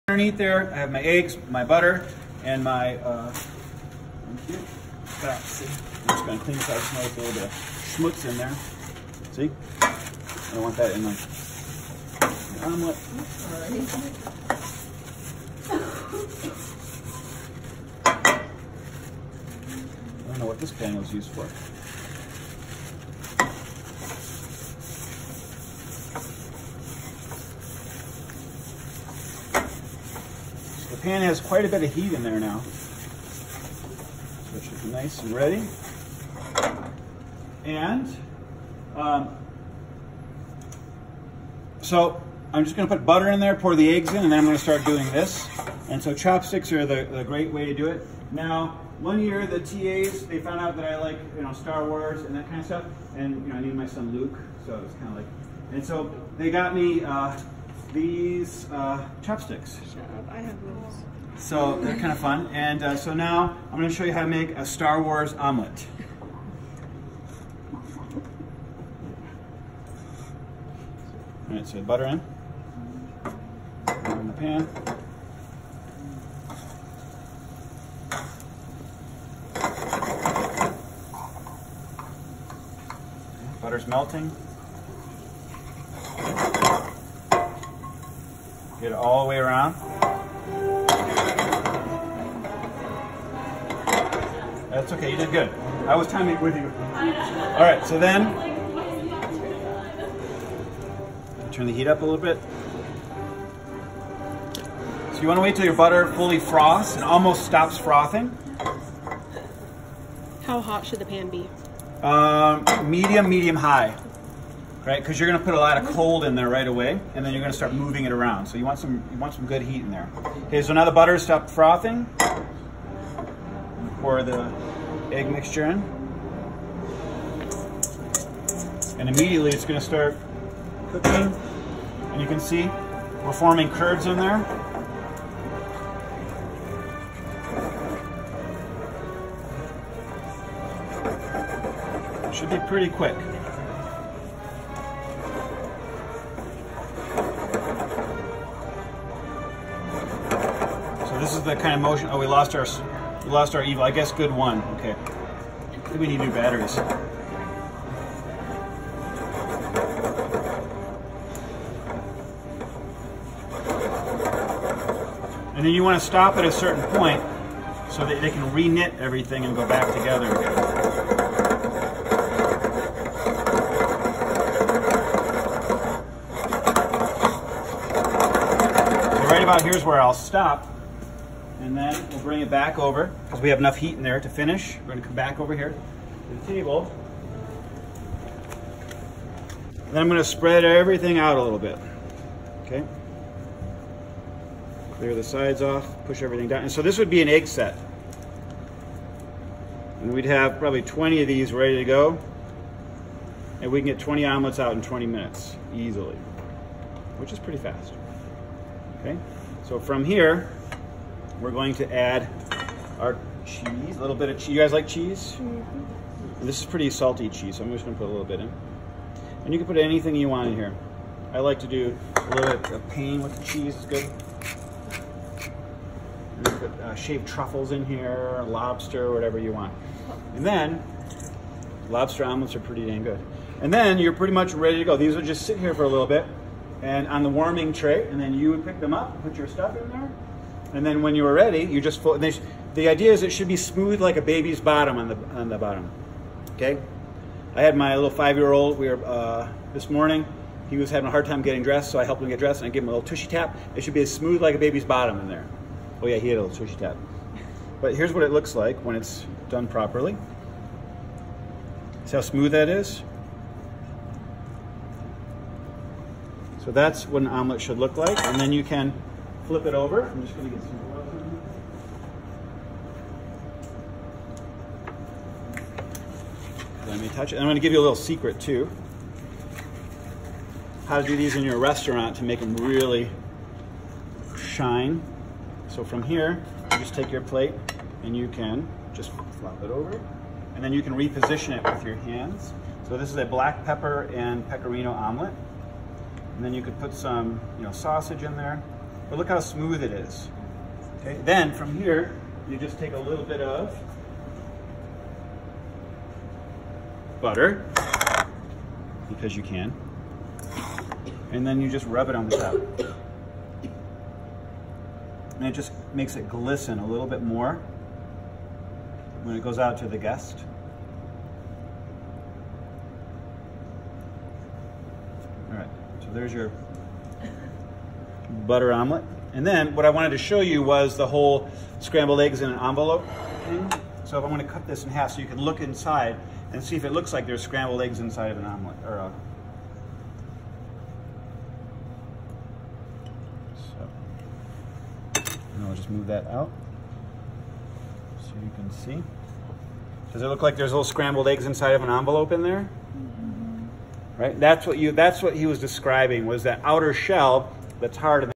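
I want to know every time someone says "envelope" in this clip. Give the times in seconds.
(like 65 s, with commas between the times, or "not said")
332 s, 351 s.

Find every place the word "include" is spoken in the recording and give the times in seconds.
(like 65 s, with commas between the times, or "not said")
not said.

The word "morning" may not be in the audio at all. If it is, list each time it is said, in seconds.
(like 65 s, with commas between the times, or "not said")
249 s.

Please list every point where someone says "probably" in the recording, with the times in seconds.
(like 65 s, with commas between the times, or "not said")
200 s.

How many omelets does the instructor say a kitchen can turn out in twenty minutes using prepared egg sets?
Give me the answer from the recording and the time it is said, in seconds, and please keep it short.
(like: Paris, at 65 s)
20, at 203 s.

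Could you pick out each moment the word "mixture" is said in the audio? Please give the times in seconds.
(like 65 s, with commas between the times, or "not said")
125 s.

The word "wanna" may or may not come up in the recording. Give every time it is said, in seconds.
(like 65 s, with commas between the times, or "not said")
105 s.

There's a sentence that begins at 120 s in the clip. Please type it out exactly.
Okay, so now the butter stopped frothing.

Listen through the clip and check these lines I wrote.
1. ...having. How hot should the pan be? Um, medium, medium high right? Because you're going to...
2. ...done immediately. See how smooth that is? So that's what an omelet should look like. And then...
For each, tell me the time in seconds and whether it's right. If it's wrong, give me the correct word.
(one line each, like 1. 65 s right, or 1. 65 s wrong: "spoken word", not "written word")
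1. 107 s wrong: "frothing", not "having"
2. 259 s wrong: "properly", not "immediately".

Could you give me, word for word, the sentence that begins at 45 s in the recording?
And so chopsticks are the, the great way to do it.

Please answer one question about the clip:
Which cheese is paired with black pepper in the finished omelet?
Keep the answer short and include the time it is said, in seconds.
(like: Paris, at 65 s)
Pecorino, at 294 s.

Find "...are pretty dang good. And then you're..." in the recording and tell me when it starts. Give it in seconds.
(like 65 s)
232 s.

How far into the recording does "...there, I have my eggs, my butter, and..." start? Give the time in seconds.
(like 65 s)
0 s.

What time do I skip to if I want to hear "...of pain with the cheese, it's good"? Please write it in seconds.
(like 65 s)
222 s.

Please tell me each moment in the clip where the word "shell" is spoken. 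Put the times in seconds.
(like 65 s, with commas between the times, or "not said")
356 s.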